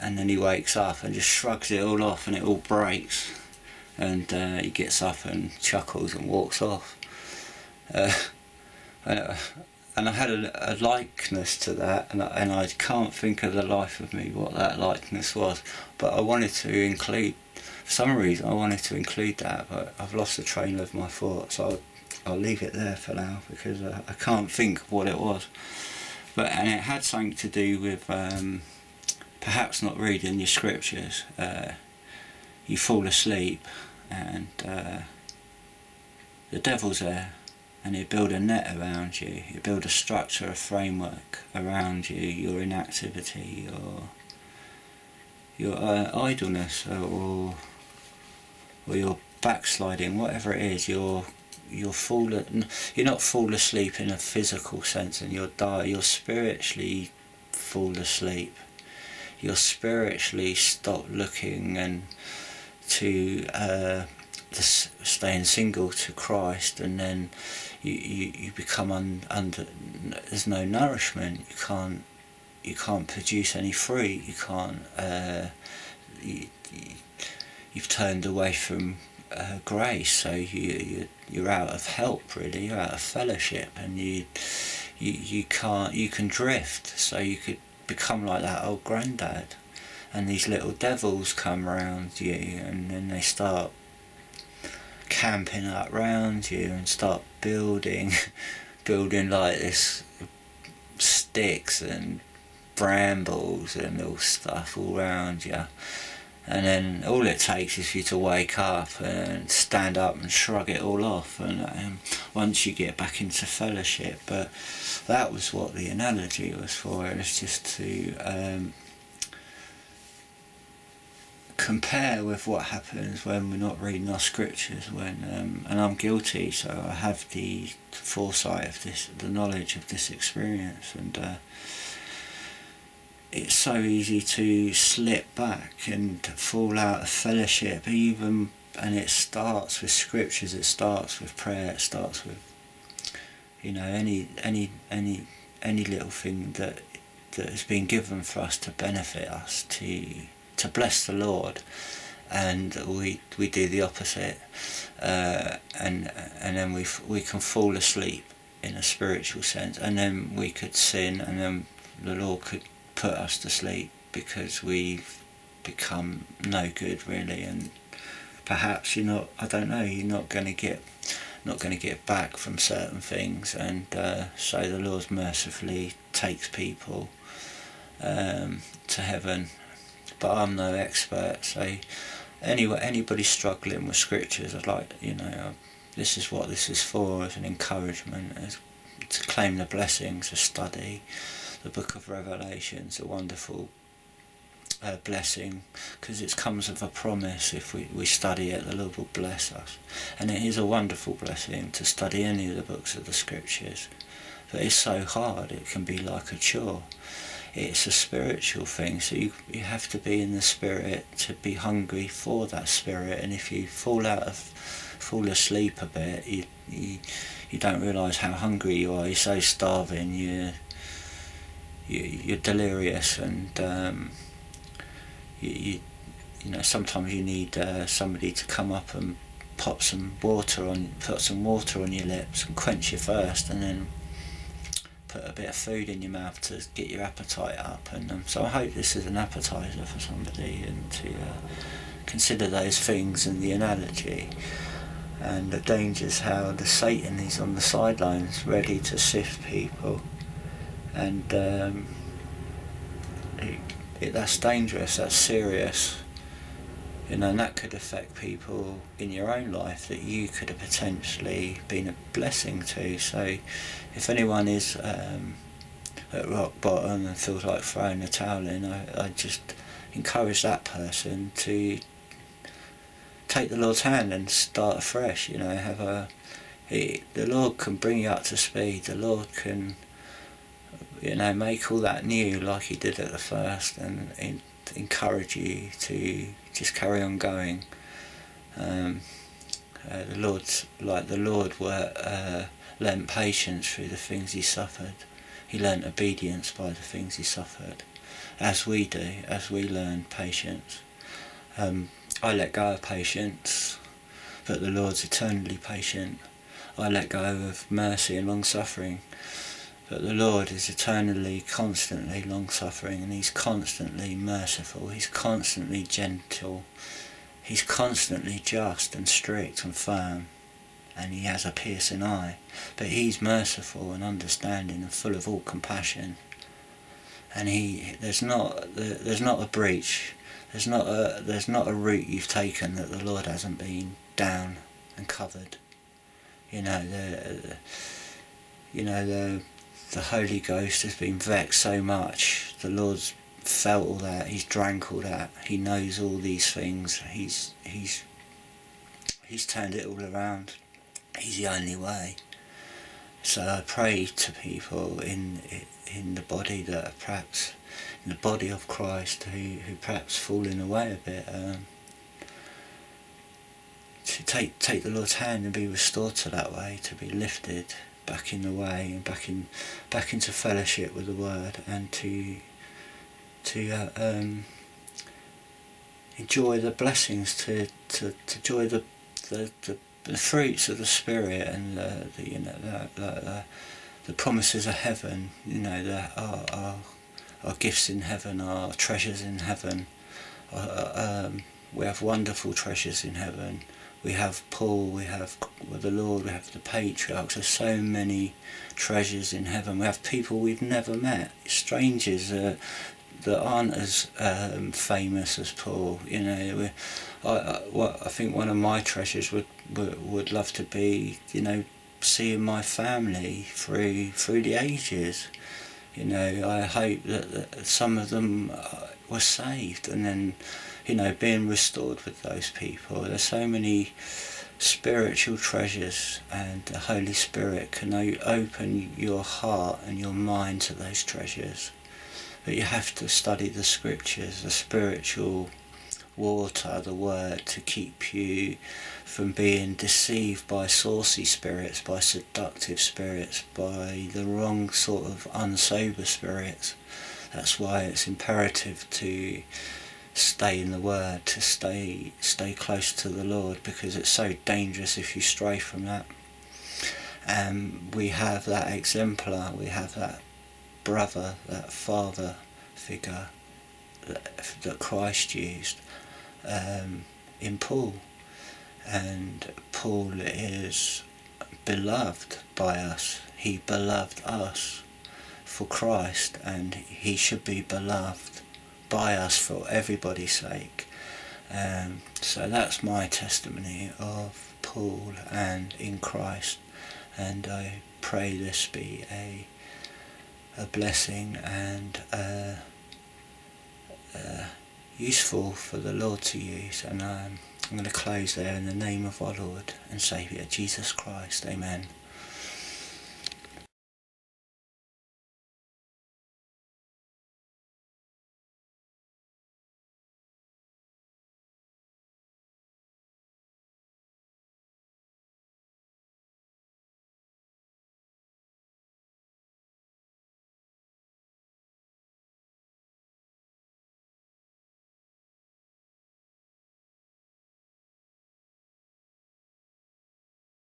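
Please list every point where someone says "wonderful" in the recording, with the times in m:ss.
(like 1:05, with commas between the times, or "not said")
3:13, 3:20, 6:32.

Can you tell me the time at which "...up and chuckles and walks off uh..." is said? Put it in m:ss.
0:05.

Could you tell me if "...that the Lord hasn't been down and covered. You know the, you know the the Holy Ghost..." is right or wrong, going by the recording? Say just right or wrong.
right.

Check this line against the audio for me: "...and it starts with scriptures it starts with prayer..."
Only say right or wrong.
right.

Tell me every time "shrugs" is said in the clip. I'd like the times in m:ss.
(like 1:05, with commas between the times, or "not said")
0:01, 1:50.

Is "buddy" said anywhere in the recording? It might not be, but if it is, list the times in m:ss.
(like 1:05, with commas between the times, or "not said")
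not said.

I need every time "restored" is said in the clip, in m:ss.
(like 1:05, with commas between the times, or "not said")
6:05, 7:01.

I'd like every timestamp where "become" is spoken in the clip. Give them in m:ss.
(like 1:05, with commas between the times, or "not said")
1:08, 1:27, 2:45.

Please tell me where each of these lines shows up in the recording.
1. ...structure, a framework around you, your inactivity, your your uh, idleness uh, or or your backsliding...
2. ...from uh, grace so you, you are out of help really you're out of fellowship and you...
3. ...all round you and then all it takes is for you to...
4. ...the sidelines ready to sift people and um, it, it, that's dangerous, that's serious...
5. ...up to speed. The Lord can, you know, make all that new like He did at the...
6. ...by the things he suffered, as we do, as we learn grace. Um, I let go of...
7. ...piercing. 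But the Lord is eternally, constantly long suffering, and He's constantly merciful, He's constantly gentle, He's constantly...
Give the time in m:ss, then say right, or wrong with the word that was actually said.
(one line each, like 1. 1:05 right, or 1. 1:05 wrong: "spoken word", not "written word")
1. 0:39 right
2. 1:18 right
3. 1:44 right
4. 4:07 right
5. 4:38 right
6. 4:56 wrong: "patience", not "grace"
7. 5:08 wrong: "suffering", not "piercing".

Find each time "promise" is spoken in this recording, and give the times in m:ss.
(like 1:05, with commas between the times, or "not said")
3:16, 6:24.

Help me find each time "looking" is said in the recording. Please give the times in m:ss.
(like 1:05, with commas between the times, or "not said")
1:01.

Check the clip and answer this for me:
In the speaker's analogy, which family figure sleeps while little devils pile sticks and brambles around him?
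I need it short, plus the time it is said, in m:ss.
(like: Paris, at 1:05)
old granddad, at 1:28.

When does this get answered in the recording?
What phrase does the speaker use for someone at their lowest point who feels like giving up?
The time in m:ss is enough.
4:26.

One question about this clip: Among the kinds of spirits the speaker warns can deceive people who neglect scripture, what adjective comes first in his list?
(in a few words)
saucy.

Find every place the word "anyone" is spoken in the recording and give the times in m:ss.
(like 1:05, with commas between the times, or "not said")
4:24.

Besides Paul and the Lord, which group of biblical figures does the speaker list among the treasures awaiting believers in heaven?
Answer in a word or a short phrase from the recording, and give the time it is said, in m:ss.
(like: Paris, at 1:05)
the patriarchs, at 6:36.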